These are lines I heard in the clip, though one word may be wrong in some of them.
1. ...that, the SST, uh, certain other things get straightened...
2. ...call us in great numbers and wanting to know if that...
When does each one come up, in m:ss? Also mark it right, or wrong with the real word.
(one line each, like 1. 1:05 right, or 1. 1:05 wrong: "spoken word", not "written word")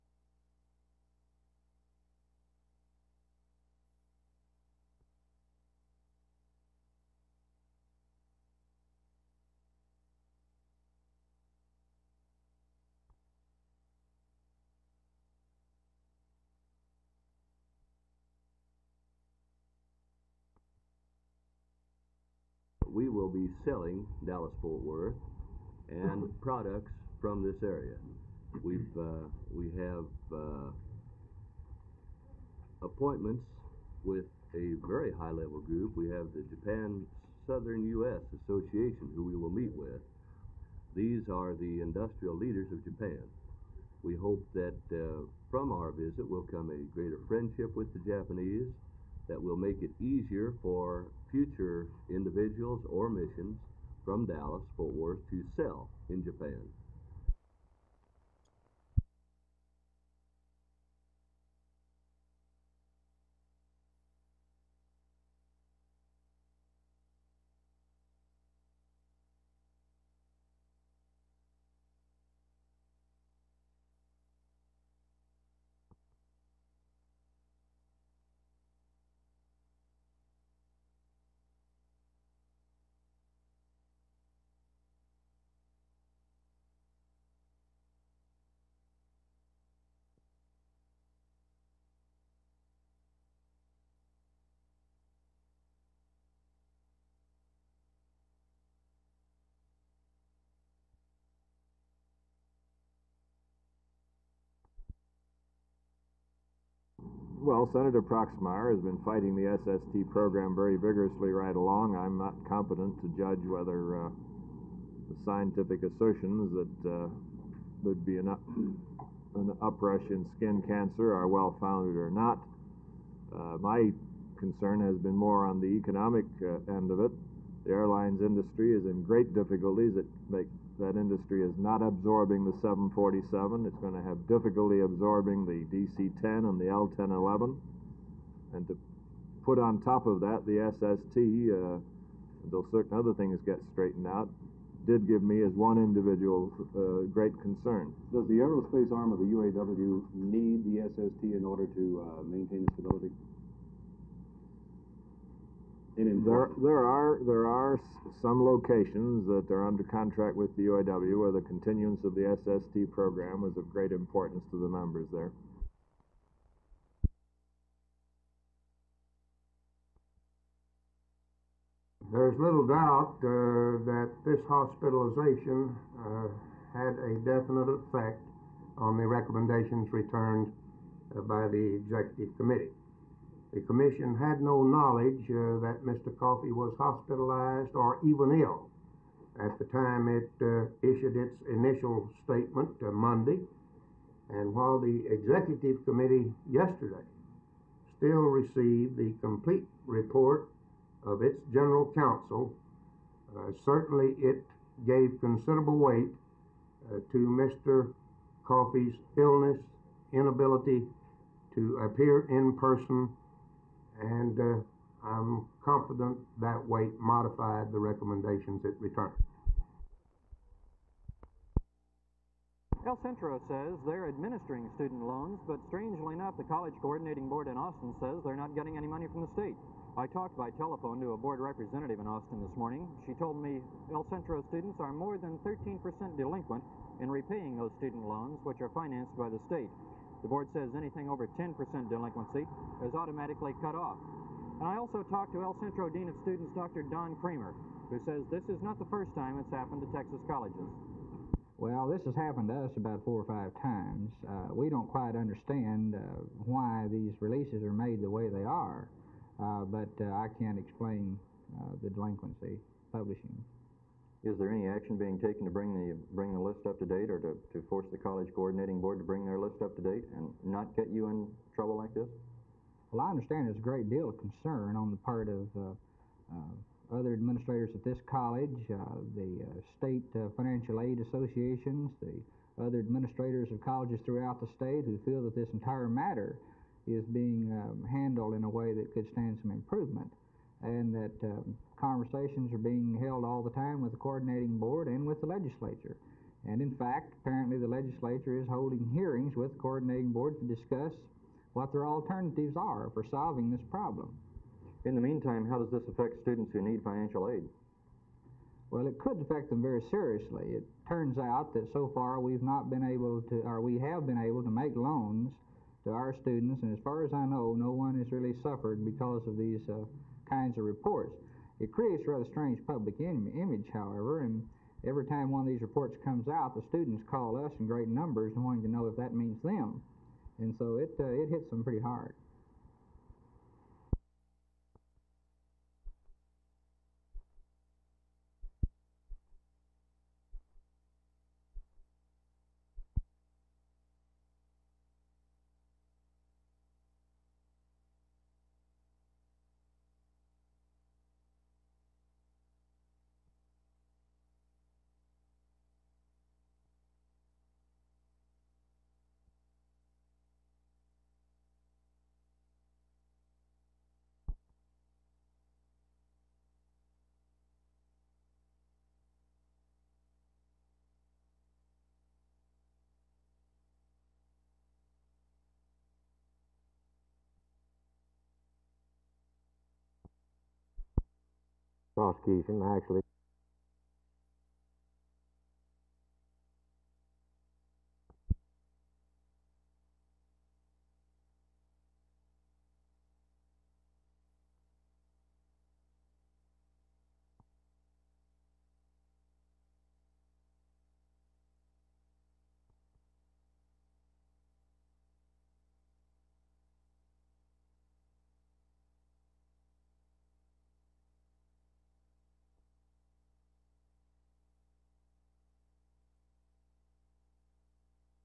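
1. 2:20 right
2. 5:27 right.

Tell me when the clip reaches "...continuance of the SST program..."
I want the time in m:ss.
2:41.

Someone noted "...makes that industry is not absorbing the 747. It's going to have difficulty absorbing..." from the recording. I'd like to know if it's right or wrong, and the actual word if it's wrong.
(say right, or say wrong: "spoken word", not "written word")
right.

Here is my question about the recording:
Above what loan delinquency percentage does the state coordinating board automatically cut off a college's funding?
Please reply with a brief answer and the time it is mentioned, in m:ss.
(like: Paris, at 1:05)
10%, at 4:01.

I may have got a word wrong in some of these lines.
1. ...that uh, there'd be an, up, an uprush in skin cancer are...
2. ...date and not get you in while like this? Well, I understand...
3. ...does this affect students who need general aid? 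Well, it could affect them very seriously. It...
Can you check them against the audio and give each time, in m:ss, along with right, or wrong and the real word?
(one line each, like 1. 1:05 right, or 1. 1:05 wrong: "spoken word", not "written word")
1. 1:56 right
2. 4:29 wrong: "trouble", not "while"
3. 5:05 wrong: "financial", not "general".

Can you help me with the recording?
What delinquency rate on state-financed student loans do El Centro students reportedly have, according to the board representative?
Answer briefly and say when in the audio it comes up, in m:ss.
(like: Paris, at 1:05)
more than 13%, at 3:54.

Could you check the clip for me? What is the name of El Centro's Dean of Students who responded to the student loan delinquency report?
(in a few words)
Don Kramer.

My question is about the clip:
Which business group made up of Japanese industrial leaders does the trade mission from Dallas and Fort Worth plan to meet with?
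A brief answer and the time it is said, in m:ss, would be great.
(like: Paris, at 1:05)
Japan Southern U.S. Association, at 0:36.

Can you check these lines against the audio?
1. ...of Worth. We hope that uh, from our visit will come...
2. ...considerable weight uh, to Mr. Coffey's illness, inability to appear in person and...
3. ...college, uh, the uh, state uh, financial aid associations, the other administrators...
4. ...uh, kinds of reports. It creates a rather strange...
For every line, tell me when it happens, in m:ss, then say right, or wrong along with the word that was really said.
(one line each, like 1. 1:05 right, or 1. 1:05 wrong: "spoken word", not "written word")
1. 0:42 wrong: "Japan", not "Worth"
2. 3:25 right
3. 4:38 right
4. 5:19 right.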